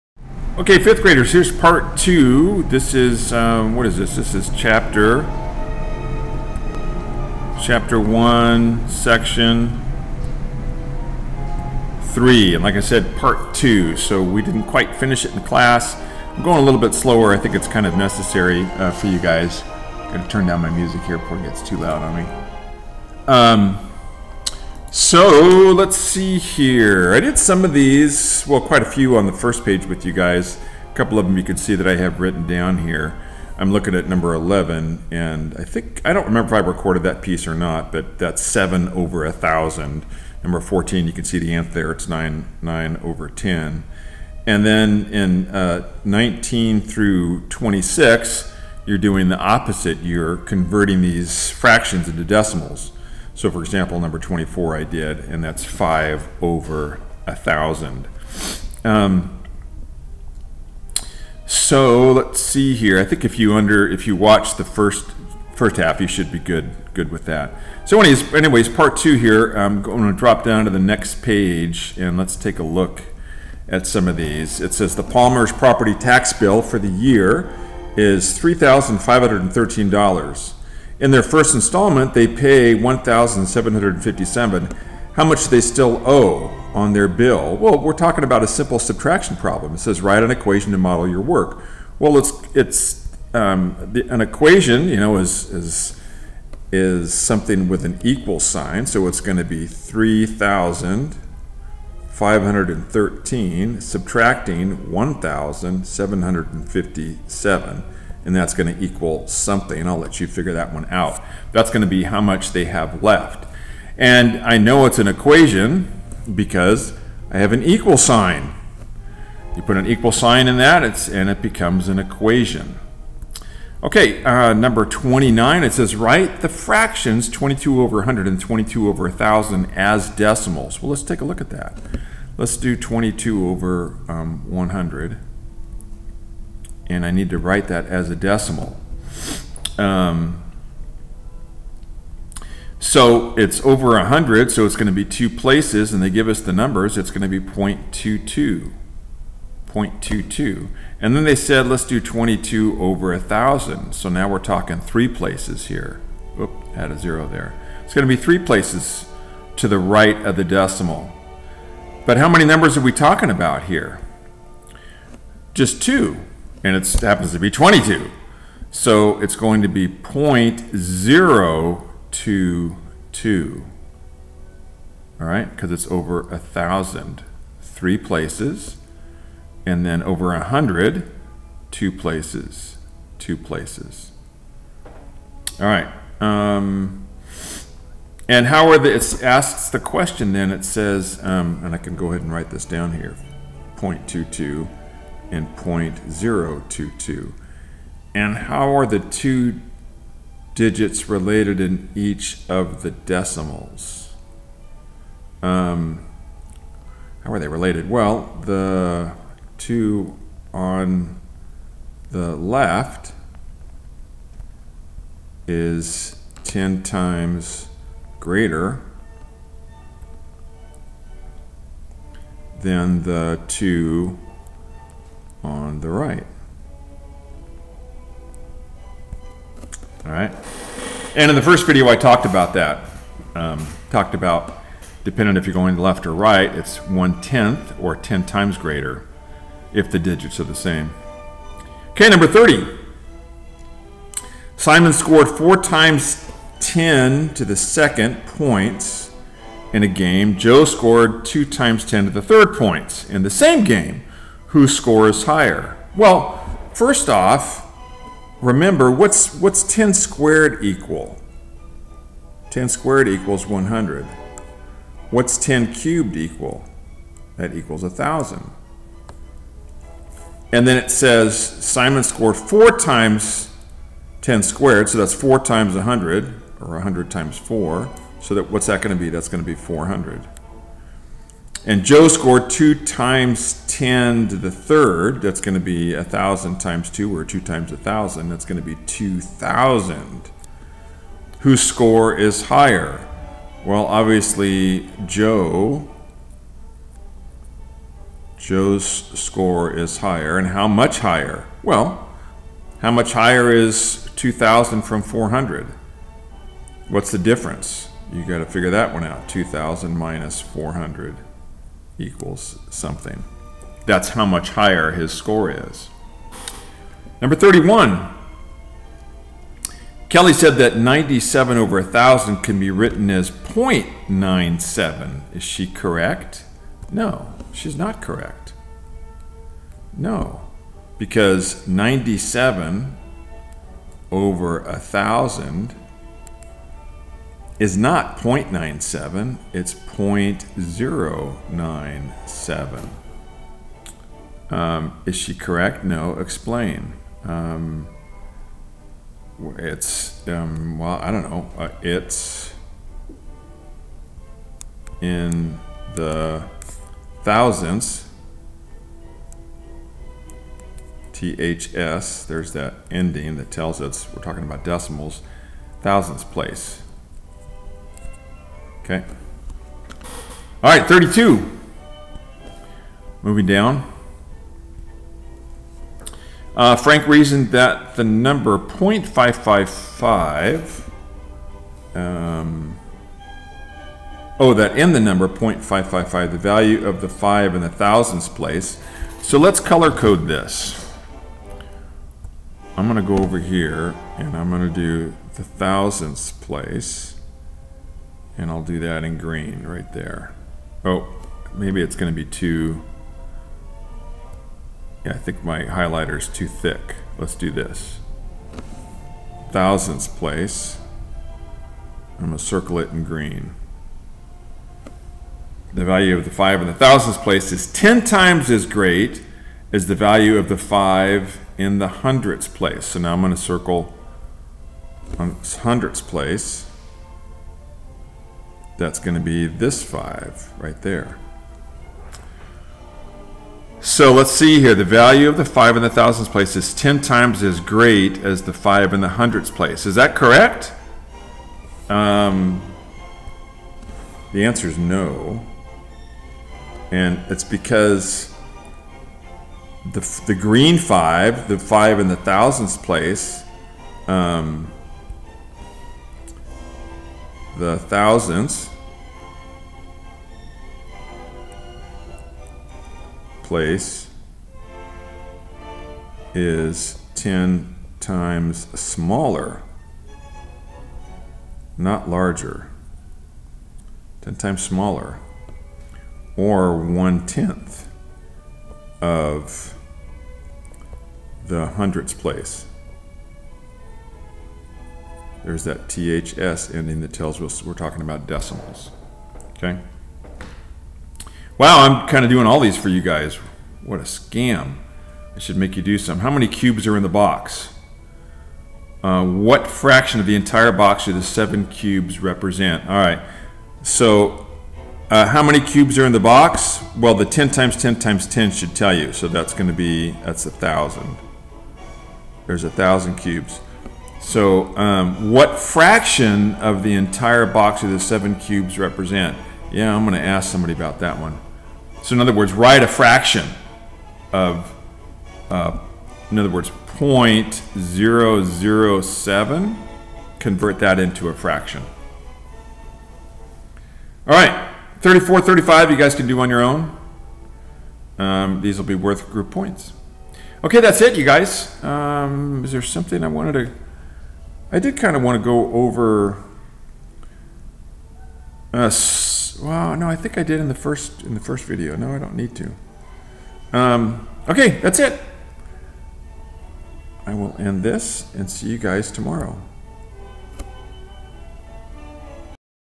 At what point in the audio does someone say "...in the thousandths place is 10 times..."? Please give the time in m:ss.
6:56.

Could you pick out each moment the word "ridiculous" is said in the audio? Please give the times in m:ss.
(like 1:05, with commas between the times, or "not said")
not said.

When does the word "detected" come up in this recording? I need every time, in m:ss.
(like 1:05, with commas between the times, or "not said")
not said.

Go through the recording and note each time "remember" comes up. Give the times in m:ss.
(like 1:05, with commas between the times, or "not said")
0:36, 4:18.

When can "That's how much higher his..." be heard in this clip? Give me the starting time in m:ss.
5:13.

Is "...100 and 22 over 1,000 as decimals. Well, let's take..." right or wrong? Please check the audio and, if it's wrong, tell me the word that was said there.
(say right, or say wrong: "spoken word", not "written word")
right.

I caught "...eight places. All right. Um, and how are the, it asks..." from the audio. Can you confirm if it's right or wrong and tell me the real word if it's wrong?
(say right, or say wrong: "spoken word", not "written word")
wrong: "two", not "eight".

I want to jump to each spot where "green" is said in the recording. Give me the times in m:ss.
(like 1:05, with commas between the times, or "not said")
6:39, 6:53, 7:30.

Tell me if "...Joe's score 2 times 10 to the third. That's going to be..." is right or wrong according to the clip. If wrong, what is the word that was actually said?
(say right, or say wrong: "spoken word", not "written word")
right.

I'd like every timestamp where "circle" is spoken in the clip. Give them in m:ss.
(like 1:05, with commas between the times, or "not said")
6:52, 7:03.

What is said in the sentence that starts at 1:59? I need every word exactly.
You put an equal sign in that, it's, and it becomes an equation.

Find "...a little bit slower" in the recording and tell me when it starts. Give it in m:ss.
0:16.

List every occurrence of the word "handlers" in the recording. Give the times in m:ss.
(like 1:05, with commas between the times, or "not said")
not said.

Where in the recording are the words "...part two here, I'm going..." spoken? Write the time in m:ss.
1:08.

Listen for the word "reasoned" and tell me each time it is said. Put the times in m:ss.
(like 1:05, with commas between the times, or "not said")
6:17.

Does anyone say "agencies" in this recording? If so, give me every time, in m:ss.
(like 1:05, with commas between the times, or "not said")
not said.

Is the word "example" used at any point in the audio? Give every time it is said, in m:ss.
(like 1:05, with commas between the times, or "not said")
0:53.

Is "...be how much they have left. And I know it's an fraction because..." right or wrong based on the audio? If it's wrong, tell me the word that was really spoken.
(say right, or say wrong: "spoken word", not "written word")
wrong: "equation", not "fraction".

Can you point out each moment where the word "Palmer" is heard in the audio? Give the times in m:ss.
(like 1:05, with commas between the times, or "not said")
1:15.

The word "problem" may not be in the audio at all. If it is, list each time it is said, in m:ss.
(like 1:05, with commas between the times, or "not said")
1:29.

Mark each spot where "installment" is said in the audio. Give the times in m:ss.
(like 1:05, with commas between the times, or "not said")
1:21.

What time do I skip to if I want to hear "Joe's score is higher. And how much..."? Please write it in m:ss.
4:58.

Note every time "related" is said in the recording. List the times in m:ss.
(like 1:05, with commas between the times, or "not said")
3:21, 3:27.